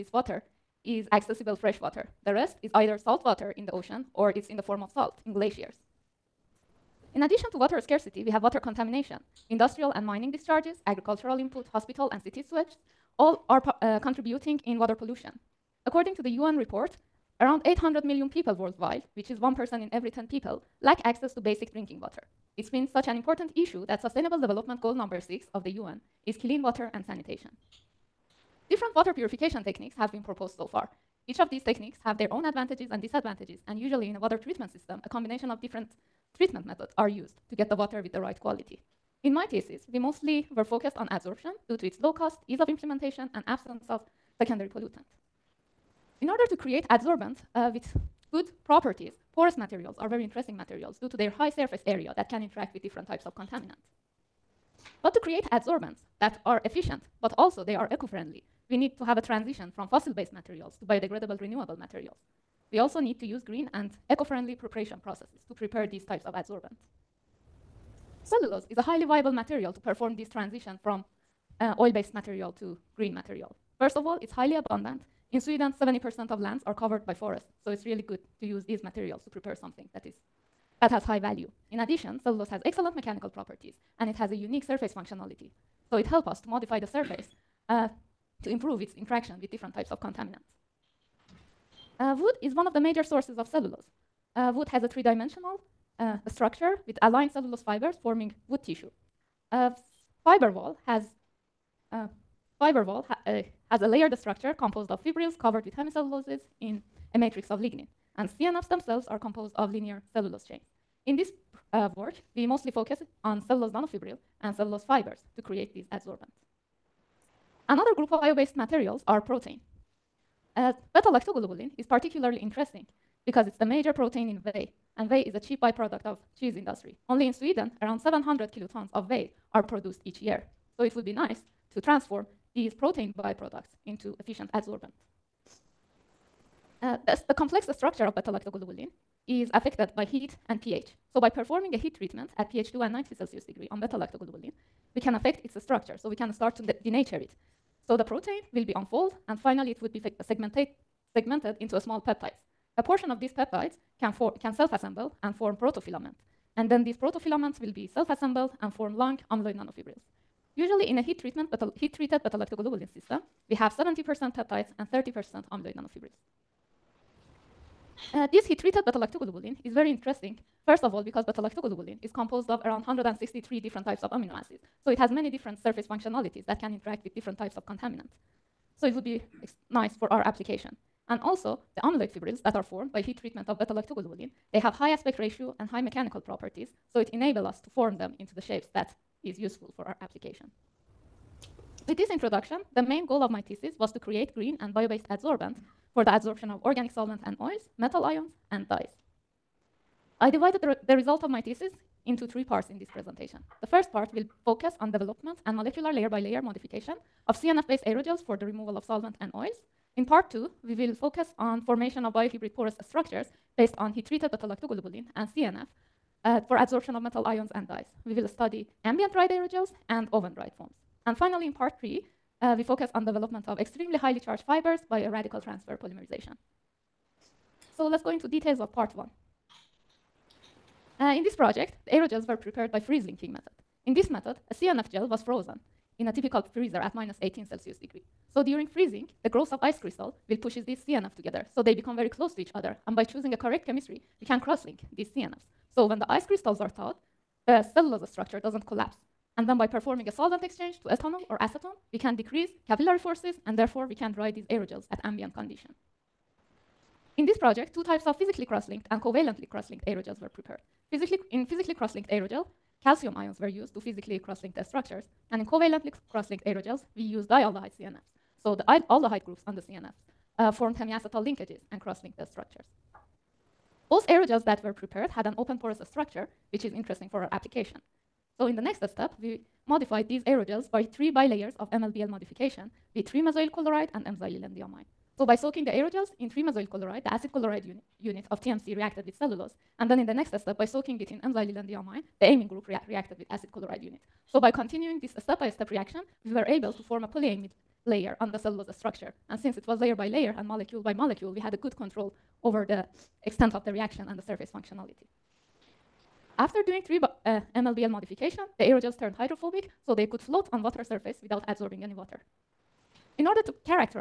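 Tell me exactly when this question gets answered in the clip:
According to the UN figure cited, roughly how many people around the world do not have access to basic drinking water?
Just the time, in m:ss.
0:17.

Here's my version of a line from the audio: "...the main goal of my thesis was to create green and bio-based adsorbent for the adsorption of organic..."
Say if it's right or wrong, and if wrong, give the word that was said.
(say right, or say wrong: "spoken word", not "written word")
right.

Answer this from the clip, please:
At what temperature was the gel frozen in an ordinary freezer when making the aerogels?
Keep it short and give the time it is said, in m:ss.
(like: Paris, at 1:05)
-18 °C, at 3:56.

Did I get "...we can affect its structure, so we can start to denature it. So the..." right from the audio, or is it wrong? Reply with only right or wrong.
right.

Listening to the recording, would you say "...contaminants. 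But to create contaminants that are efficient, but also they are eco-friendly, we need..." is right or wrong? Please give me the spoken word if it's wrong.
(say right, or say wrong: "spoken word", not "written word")
wrong: "adsorbents", not "contaminants".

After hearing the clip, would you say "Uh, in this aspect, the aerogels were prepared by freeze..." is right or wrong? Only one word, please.
wrong.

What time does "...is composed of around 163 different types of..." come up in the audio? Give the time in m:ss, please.
2:52.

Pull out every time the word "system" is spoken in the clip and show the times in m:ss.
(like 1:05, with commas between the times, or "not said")
0:34, 2:42.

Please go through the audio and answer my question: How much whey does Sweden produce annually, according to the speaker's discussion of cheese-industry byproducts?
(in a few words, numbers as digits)
700 kilotons.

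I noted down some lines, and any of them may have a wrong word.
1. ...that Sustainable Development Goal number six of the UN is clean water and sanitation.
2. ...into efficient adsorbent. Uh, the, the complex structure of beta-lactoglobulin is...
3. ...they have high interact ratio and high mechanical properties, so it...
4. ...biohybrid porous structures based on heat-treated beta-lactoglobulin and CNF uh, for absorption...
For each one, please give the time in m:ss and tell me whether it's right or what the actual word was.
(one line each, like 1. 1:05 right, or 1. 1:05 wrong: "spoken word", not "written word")
1. 0:23 right
2. 2:13 right
3. 3:04 wrong: "aspect", not "interact"
4. 3:32 right.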